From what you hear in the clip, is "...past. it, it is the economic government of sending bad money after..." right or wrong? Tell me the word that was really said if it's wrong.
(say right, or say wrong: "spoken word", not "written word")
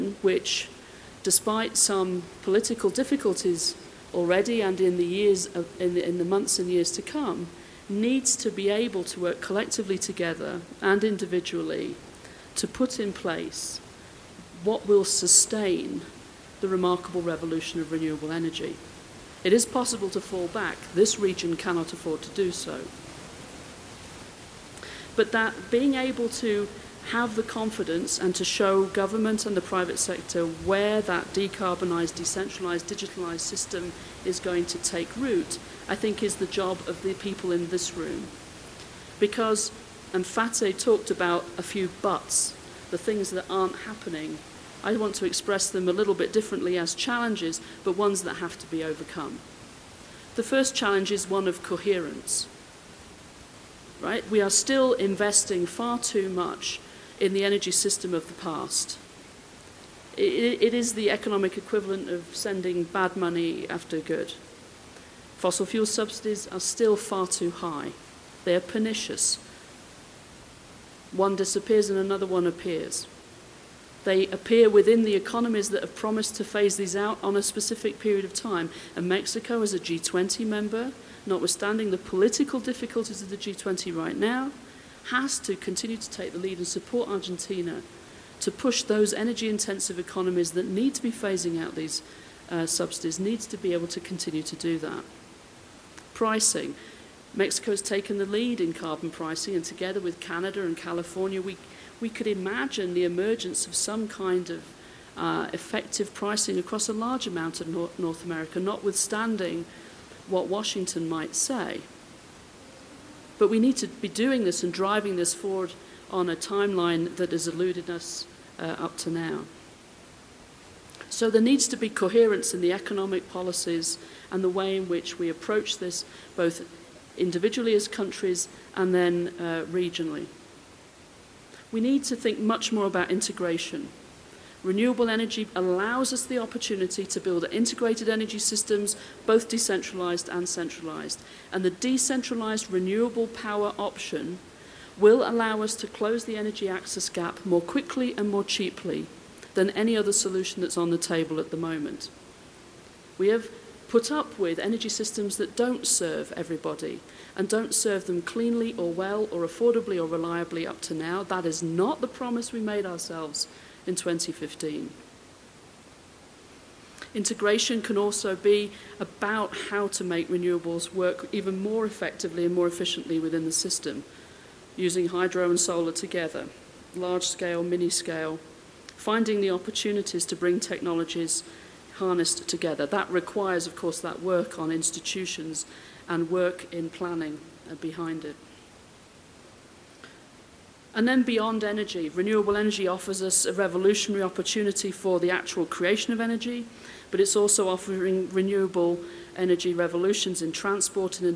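wrong: "equivalent", not "government".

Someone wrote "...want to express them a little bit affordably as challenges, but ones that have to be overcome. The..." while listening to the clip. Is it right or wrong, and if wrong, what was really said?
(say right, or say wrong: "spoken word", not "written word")
wrong: "differently", not "affordably".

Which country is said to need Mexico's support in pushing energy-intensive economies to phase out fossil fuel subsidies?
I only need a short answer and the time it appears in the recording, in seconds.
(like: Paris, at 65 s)
Argentina, at 87 s.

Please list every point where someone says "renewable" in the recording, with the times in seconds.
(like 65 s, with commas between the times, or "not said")
17 s, 134 s, 142 s, 170 s, 192 s, 198 s.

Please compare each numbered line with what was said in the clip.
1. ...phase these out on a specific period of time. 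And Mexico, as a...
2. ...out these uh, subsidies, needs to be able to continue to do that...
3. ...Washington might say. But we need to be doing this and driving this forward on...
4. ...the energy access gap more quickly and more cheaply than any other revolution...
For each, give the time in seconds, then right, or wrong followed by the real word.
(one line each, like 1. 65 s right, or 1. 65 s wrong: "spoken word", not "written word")
1. 76 s right
2. 91 s right
3. 110 s right
4. 146 s wrong: "solution", not "revolution".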